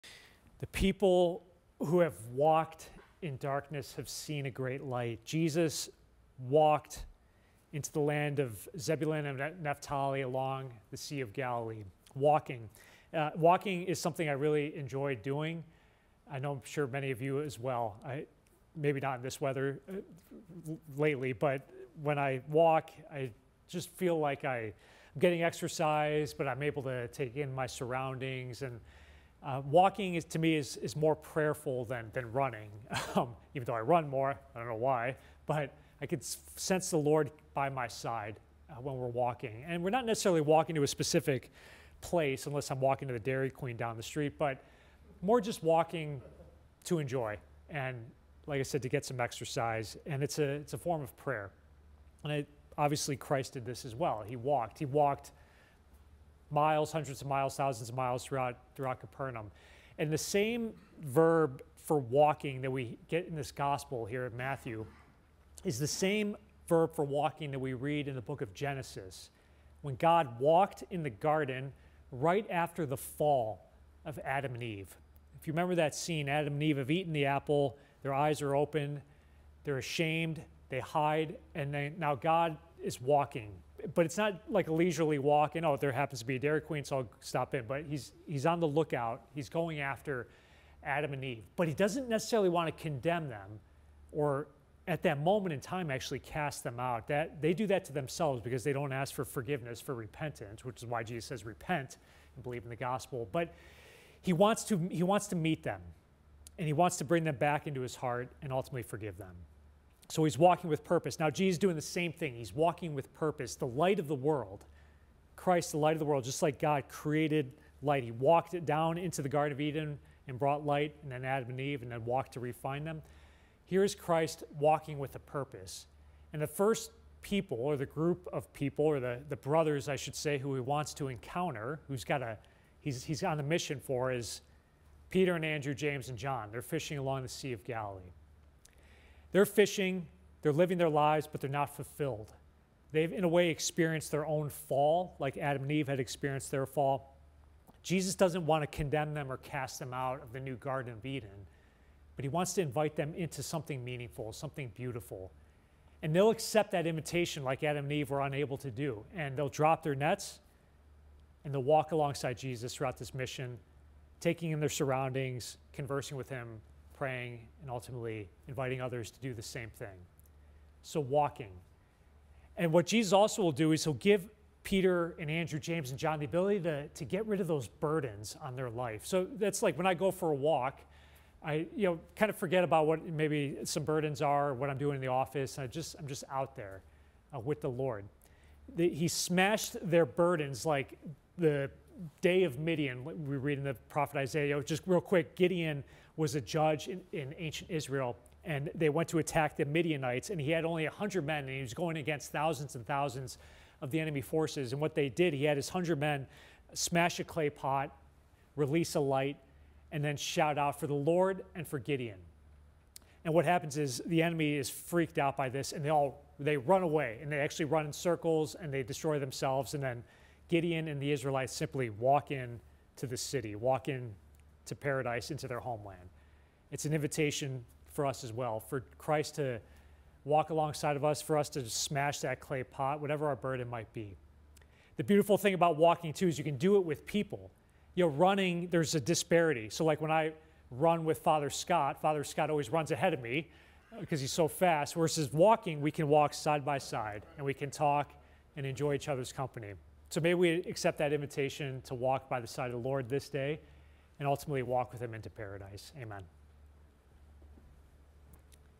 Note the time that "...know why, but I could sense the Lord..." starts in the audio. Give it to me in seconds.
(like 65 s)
34 s.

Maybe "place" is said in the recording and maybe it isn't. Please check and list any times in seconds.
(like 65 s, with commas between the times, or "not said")
42 s.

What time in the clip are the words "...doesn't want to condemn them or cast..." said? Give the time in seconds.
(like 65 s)
148 s.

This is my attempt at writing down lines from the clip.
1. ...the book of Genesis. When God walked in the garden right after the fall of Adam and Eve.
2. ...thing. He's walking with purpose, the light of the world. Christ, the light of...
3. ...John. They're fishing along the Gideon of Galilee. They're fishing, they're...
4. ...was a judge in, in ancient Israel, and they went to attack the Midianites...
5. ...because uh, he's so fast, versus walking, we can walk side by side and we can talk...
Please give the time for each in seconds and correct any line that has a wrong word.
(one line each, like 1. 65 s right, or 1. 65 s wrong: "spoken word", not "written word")
1. 68 s right
2. 112 s right
3. 136 s wrong: "Sea", not "Gideon"
4. 196 s right
5. 243 s right.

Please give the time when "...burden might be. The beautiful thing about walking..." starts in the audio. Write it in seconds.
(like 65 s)
233 s.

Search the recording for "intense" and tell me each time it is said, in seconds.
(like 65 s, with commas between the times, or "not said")
not said.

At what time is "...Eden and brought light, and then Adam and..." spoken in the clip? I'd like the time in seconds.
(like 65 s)
119 s.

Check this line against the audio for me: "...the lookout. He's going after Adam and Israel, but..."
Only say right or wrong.
wrong.